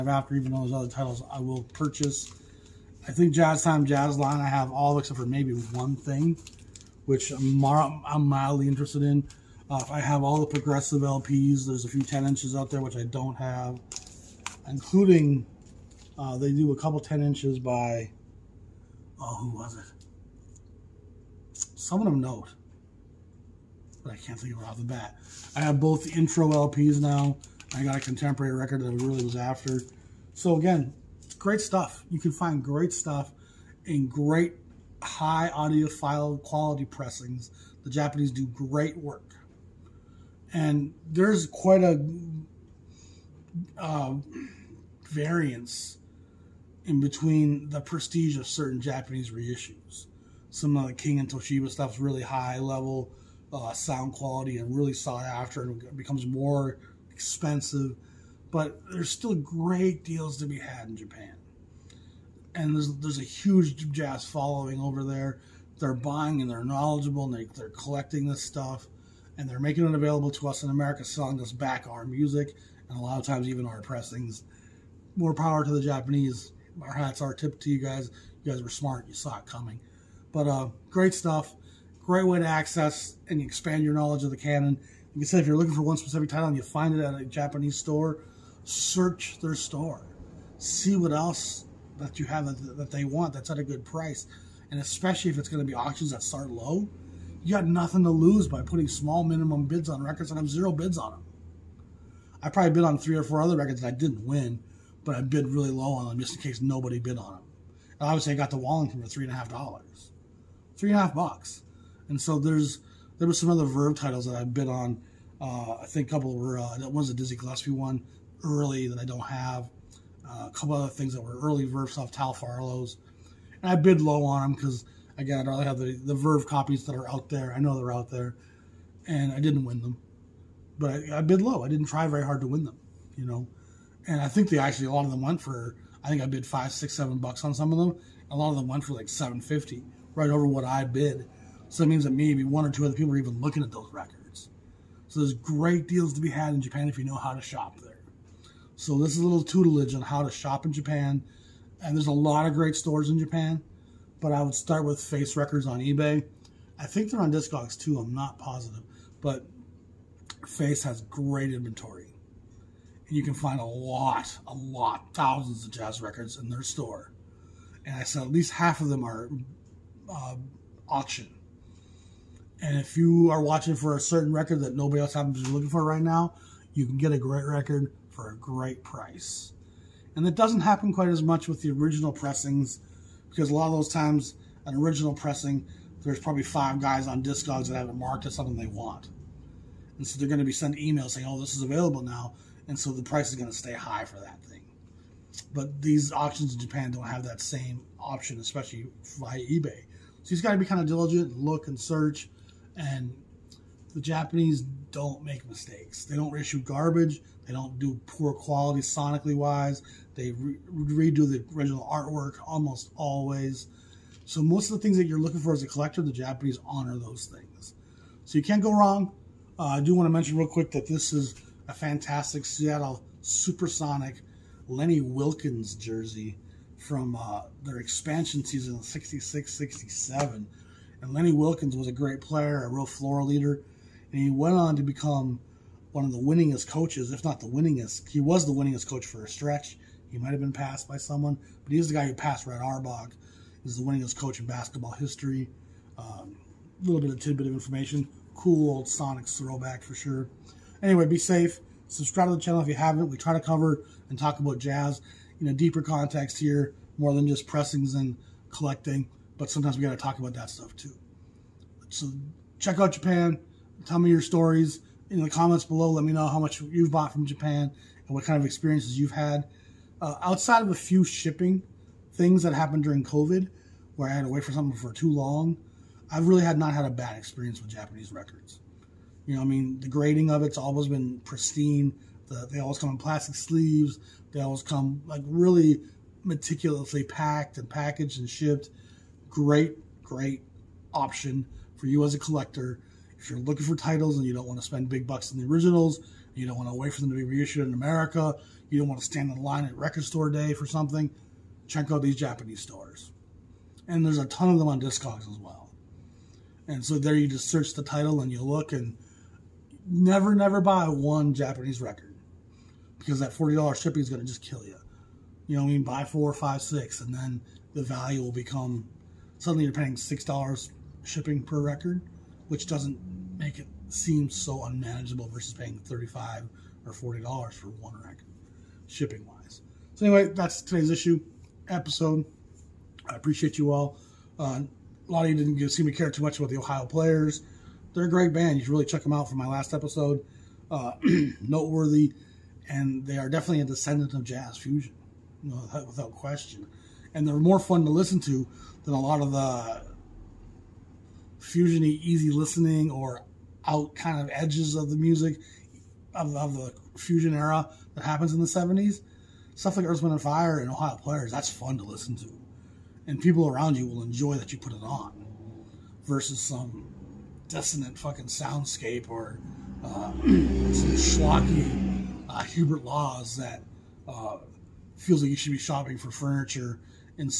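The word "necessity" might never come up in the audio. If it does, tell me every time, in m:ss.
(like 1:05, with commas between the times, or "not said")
not said.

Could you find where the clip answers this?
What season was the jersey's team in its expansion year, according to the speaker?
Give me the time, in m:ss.
3:48.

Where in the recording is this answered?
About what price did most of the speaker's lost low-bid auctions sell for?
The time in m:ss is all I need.
2:19.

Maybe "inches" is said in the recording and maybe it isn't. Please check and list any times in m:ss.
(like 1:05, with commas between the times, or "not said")
0:12, 0:17.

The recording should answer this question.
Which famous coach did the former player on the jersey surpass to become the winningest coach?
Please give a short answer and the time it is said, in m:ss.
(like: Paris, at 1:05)
Red Auerbach, at 4:02.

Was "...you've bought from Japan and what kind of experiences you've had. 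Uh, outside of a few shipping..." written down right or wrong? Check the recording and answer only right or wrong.
right.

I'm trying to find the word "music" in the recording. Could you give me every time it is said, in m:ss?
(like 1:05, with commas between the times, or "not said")
1:12, 5:54.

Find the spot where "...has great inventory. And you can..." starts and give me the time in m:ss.
2:40.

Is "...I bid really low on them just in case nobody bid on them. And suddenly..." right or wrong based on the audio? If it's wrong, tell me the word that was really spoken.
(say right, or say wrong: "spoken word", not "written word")
wrong: "obviously", not "suddenly".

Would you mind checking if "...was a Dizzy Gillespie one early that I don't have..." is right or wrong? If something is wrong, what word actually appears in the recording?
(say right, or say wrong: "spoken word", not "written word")
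right.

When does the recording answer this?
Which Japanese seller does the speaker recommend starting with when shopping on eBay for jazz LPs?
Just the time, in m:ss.
2:35.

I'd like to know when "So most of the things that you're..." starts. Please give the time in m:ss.
3:34.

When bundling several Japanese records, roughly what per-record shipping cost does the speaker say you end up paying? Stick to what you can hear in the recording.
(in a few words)
$6.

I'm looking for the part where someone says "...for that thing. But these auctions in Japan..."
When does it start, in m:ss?
3:14.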